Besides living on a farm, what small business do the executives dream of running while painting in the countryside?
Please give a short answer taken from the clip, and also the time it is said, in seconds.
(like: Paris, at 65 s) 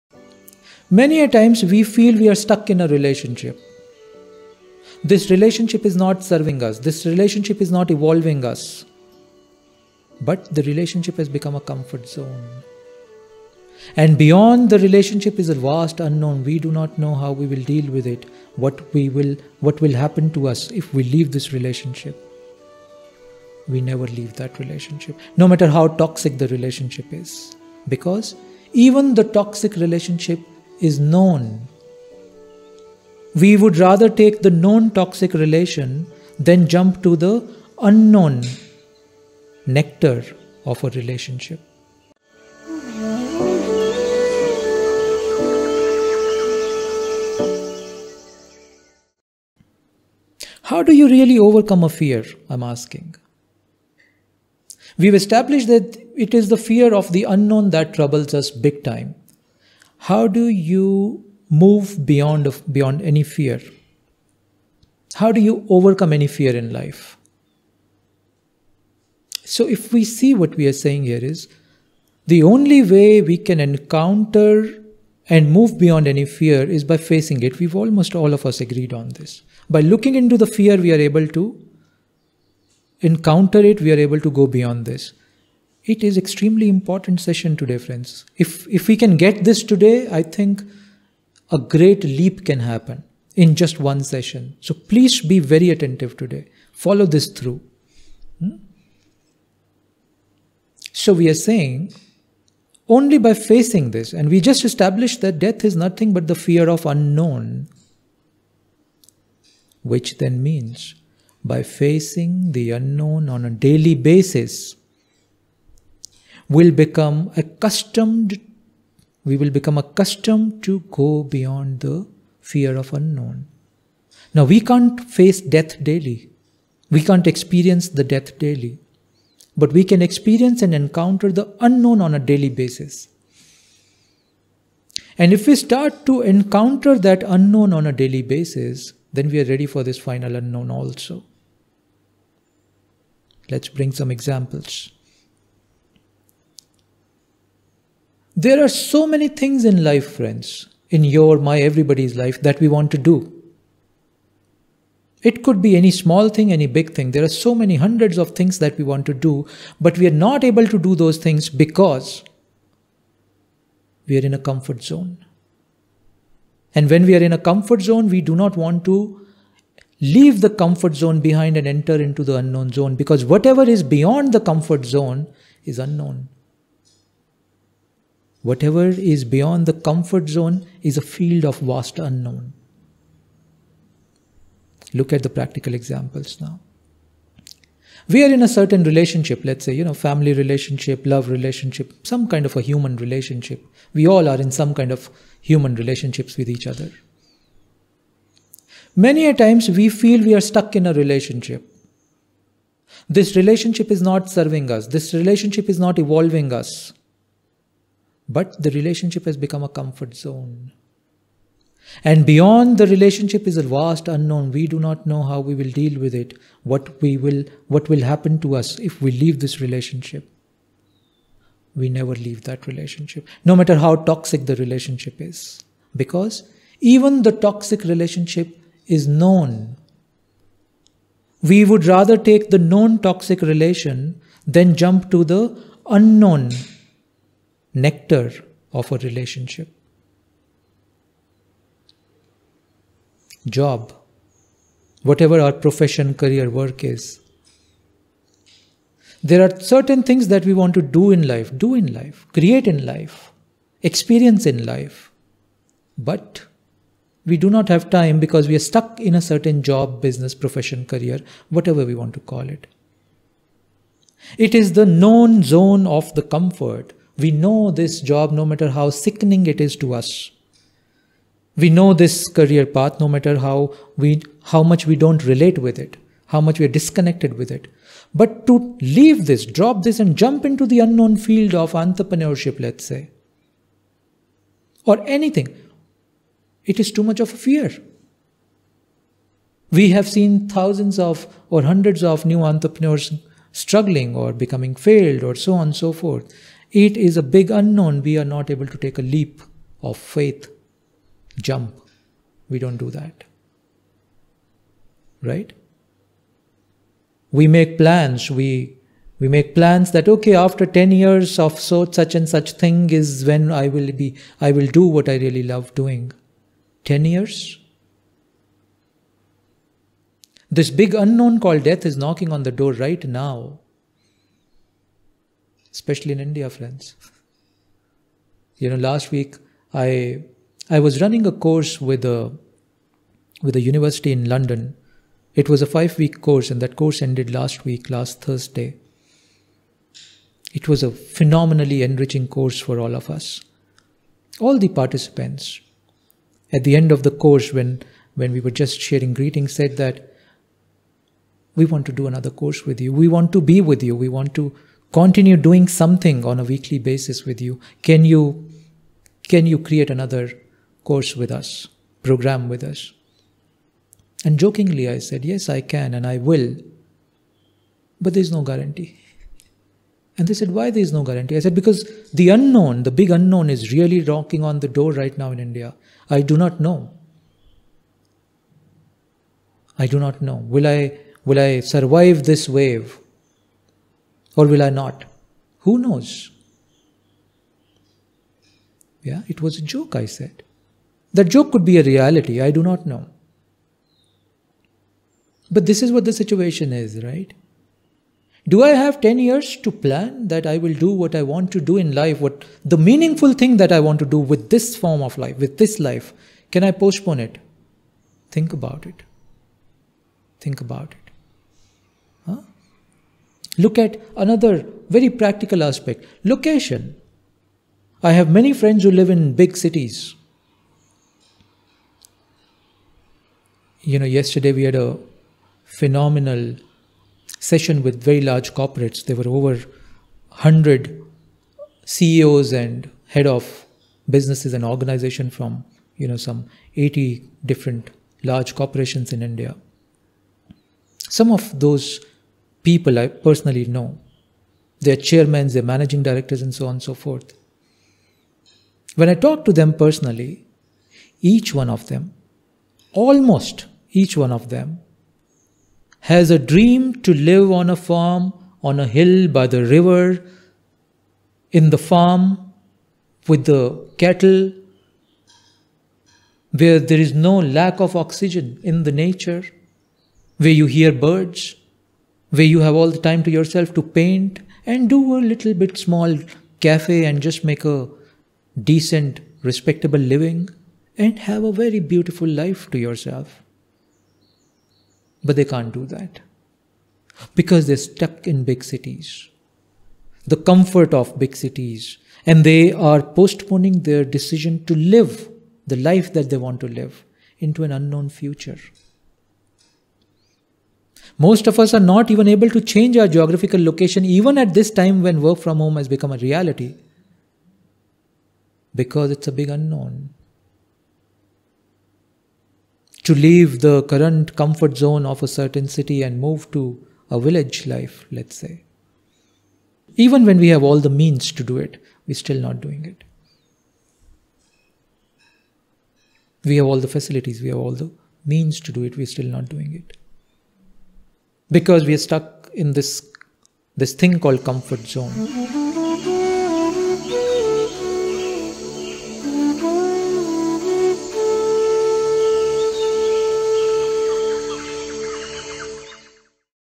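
small cafe, at 475 s.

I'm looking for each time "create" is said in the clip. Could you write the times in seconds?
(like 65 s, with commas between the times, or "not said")
252 s, 359 s.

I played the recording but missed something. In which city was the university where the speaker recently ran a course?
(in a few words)
London.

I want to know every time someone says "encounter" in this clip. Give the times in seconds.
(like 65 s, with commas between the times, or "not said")
73 s, 83 s, 130 s, 136 s.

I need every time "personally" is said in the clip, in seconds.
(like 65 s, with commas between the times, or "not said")
443 s, 449 s.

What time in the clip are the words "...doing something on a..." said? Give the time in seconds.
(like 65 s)
355 s.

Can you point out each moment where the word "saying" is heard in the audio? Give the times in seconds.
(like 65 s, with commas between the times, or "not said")
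70 s, 101 s.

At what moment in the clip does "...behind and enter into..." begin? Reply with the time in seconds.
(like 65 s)
171 s.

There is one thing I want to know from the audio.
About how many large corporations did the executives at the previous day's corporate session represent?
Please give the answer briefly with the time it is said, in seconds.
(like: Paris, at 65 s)
80, at 436 s.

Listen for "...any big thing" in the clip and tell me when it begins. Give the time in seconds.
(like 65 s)
156 s.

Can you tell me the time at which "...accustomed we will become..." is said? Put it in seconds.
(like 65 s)
117 s.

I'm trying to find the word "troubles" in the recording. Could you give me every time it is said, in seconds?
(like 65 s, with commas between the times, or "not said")
57 s.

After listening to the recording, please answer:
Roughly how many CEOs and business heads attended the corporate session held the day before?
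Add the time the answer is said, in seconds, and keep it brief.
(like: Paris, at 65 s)
over 100, at 429 s.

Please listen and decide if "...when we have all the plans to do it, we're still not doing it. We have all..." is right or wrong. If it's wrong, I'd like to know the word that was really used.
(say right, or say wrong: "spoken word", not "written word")
wrong: "means", not "plans".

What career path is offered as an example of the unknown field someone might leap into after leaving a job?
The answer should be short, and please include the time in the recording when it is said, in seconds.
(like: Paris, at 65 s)
entrepreneurship, at 281 s.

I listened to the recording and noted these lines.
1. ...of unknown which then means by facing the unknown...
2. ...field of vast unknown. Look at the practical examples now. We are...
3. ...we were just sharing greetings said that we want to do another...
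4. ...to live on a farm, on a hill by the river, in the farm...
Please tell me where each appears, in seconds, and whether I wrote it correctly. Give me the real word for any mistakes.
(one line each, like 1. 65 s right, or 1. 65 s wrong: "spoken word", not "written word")
1. 106 s right
2. 181 s right
3. 348 s right
4. 457 s right.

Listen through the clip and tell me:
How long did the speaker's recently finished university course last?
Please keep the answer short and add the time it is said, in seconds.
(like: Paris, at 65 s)
5 weeks, at 335 s.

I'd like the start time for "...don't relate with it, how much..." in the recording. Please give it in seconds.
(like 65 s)
275 s.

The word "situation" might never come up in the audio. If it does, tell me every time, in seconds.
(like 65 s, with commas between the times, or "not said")
396 s.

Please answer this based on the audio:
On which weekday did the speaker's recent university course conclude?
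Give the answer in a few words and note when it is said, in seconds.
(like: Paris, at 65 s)
Thursday, at 338 s.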